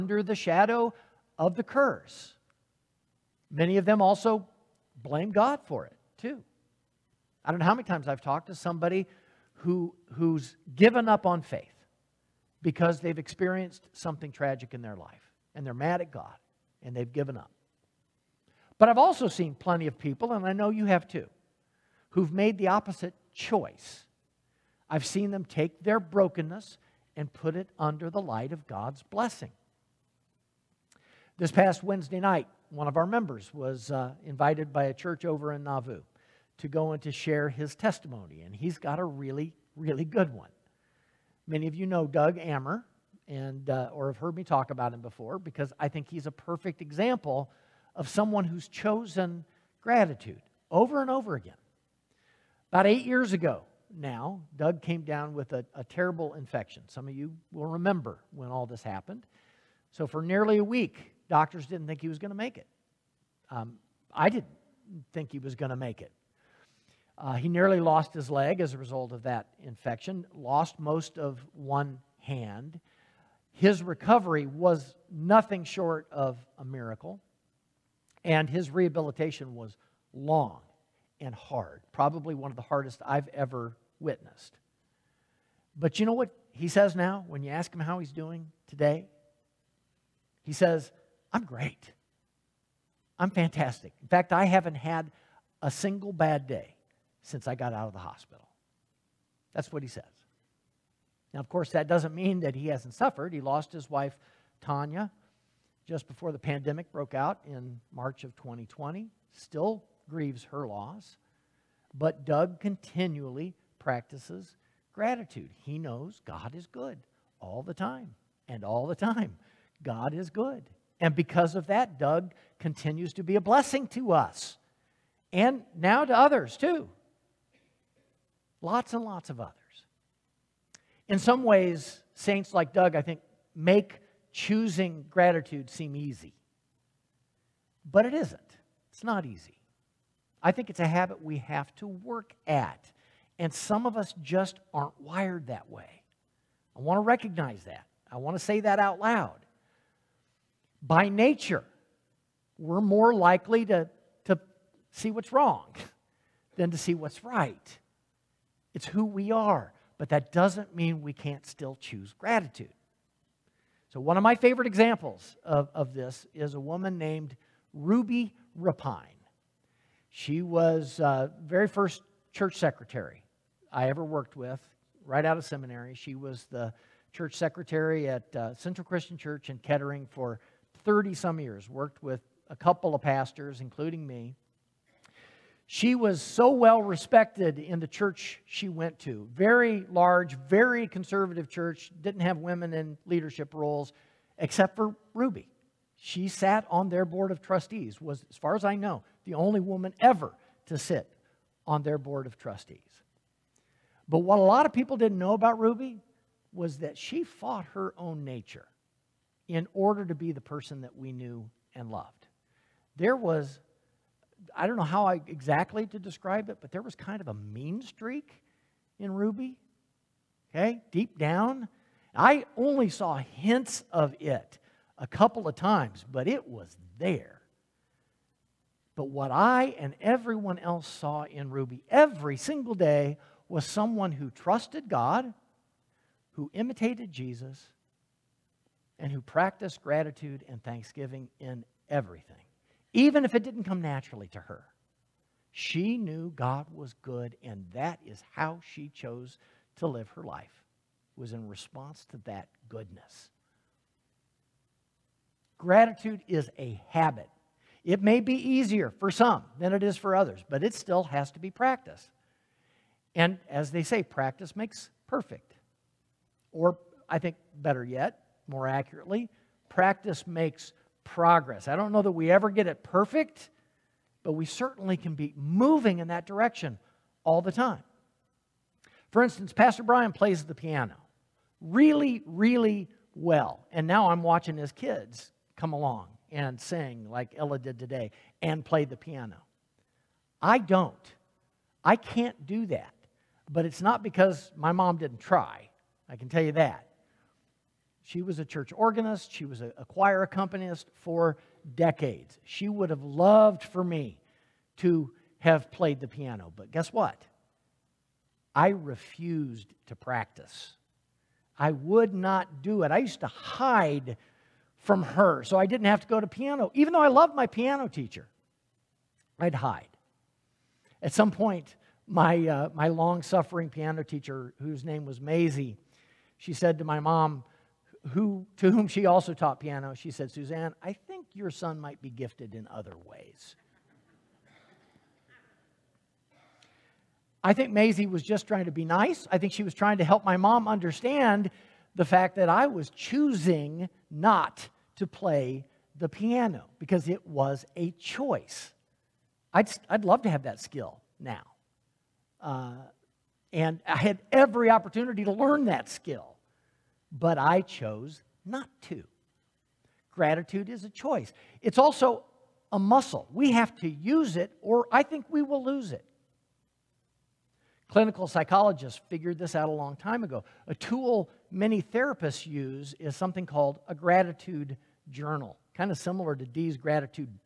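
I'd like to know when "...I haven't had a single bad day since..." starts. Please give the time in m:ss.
1:34.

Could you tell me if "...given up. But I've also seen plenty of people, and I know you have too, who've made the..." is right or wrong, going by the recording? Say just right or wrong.
right.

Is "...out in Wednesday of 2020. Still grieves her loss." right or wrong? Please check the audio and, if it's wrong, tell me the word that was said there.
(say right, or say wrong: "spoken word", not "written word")
wrong: "March", not "Wednesday".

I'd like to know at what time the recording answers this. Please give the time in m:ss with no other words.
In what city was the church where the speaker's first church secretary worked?
2:59.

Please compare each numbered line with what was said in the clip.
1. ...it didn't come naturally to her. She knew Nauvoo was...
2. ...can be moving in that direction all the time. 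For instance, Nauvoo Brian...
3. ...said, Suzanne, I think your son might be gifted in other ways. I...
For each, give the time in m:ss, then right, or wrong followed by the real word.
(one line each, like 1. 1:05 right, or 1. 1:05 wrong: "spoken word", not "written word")
1. 4:03 wrong: "God", not "Nauvoo"
2. 4:34 wrong: "Pastor", not "Nauvoo"
3. 5:30 right.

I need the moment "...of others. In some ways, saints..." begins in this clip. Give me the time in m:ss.
2:09.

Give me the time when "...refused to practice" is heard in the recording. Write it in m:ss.
5:08.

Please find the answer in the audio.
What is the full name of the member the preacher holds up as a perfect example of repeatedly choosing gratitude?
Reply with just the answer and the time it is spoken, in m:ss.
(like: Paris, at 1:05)
Doug Ammer, at 0:42.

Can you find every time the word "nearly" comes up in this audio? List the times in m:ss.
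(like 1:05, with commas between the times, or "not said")
1:00, 1:07.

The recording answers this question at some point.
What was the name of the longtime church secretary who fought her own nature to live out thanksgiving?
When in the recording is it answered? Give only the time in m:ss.
2:47.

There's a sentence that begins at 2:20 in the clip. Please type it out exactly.
I think it's a habit we have to work at.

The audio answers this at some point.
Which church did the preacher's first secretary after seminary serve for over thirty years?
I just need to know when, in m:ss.
2:58.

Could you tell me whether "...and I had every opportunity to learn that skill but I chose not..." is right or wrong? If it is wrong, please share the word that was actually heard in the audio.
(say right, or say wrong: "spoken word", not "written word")
right.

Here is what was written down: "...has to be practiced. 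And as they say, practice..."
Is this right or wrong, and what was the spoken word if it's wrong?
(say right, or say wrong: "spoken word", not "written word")
right.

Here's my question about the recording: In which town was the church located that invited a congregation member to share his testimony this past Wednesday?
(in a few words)
Nauvoo.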